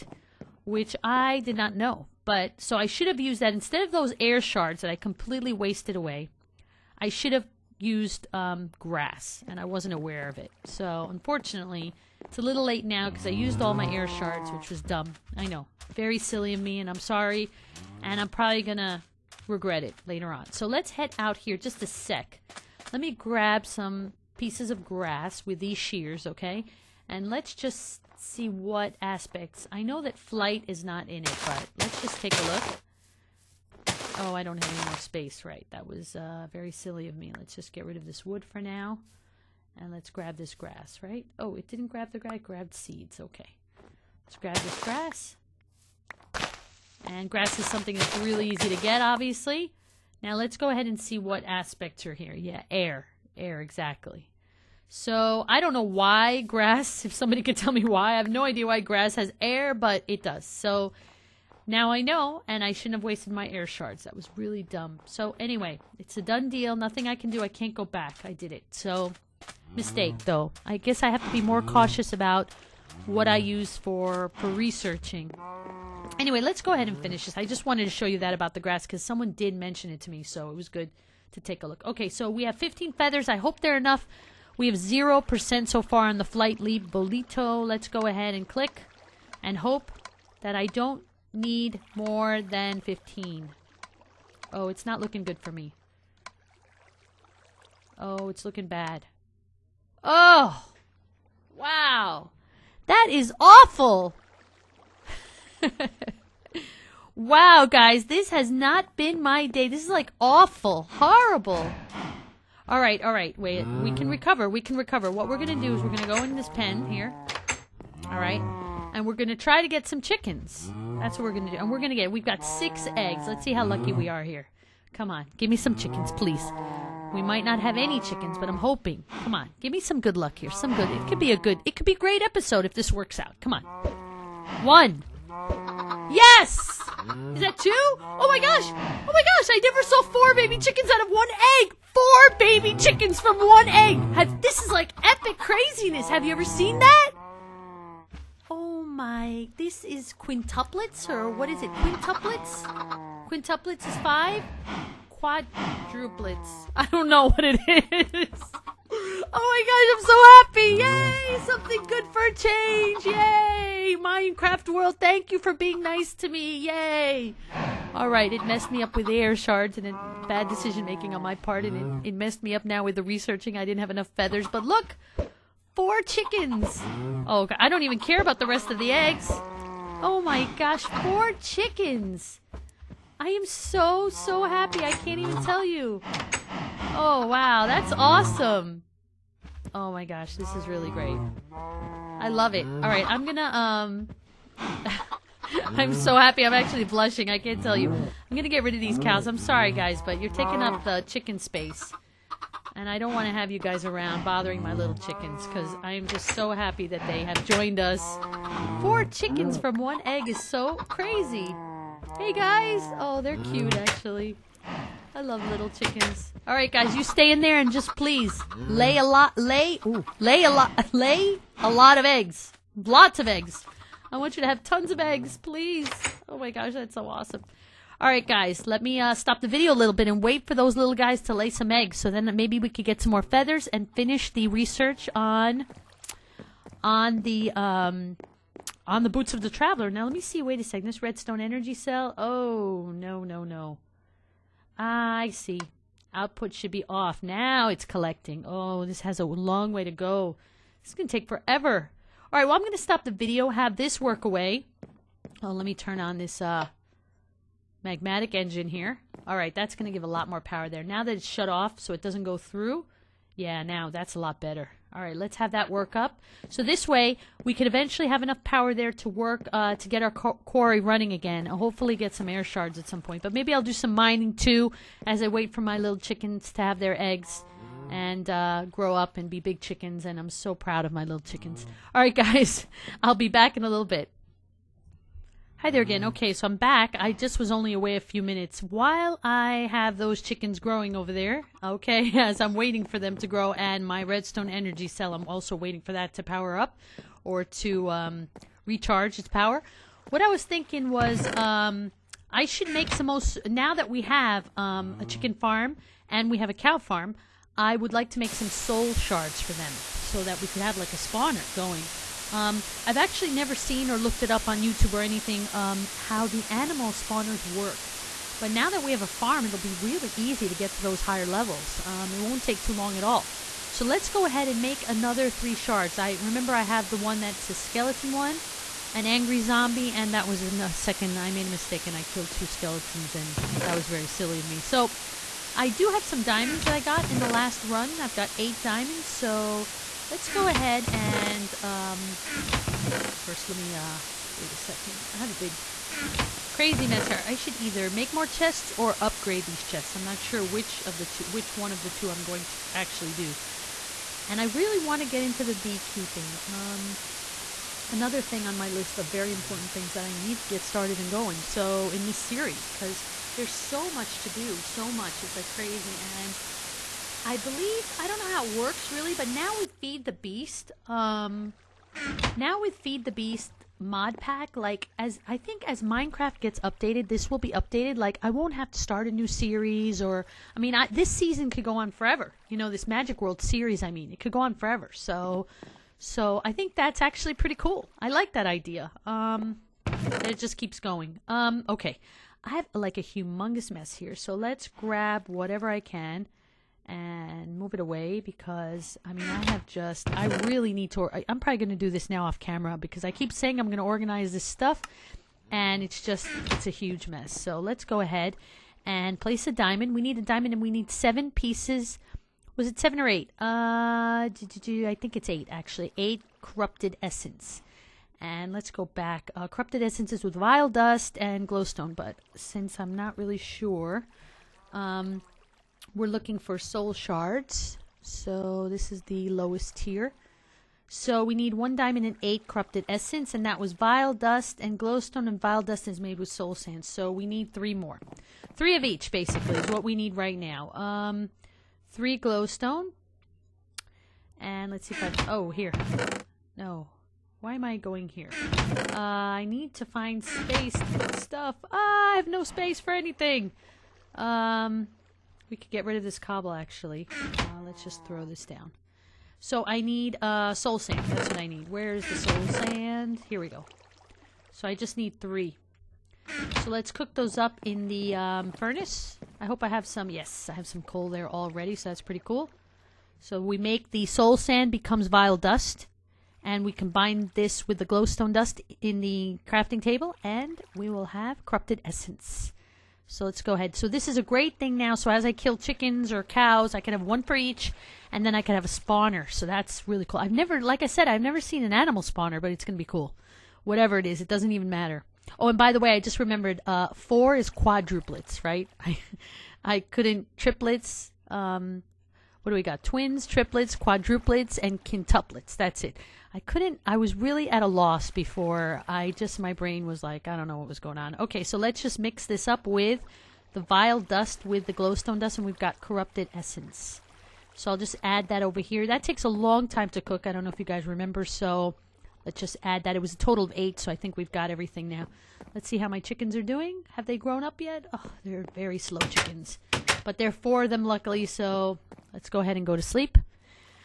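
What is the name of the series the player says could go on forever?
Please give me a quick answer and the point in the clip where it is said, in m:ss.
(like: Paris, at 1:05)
Magic World, at 6:22.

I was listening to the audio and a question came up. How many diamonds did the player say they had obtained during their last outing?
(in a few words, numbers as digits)
8.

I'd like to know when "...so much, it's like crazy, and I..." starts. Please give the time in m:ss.
6:04.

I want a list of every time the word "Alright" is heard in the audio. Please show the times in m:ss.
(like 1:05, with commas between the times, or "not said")
2:47.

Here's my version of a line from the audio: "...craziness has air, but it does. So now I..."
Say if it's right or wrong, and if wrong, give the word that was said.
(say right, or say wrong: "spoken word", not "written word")
wrong: "grass", not "craziness".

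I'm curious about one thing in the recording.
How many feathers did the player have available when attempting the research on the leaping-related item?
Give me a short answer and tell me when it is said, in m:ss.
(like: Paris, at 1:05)
15, at 1:22.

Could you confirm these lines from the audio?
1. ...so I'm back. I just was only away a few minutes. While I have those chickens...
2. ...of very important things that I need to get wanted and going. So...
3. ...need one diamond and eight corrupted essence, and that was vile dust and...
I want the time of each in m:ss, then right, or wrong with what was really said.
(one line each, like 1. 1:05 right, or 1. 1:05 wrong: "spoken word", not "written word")
1. 4:46 right
2. 5:58 wrong: "started", not "wanted"
3. 7:11 right.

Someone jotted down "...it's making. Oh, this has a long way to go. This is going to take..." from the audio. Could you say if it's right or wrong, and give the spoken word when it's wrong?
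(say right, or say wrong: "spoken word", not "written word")
wrong: "collecting", not "making".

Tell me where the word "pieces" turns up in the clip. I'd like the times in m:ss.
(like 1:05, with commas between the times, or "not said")
0:24, 6:51.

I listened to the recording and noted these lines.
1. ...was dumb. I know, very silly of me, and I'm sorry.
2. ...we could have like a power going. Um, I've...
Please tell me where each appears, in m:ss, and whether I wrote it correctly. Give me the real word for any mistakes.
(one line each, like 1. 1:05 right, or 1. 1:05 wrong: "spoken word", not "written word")
1. 0:14 right
2. 5:10 wrong: "spawner", not "power".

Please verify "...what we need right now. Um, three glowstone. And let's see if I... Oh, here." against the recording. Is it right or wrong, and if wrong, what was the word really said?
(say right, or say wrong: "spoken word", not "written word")
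right.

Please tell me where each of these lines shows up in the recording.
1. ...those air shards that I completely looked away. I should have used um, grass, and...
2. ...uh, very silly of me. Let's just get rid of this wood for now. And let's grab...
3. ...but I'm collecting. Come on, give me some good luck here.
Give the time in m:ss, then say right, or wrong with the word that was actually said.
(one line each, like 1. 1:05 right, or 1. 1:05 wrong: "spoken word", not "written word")
1. 0:03 wrong: "wasted", not "looked"
2. 0:36 right
3. 2:08 wrong: "hoping", not "collecting".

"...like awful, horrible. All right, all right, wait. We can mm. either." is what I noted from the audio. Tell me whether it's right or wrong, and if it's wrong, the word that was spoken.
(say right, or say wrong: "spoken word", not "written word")
wrong: "recover", not "either".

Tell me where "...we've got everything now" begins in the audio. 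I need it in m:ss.
8:44.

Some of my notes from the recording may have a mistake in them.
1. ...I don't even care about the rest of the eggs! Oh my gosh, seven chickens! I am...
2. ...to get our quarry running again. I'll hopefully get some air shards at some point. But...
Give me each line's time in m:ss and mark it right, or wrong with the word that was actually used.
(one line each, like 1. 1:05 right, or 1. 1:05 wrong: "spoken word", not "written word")
1. 2:57 wrong: "four", not "seven"
2. 4:29 right.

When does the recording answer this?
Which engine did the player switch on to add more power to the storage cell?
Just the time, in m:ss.
4:17.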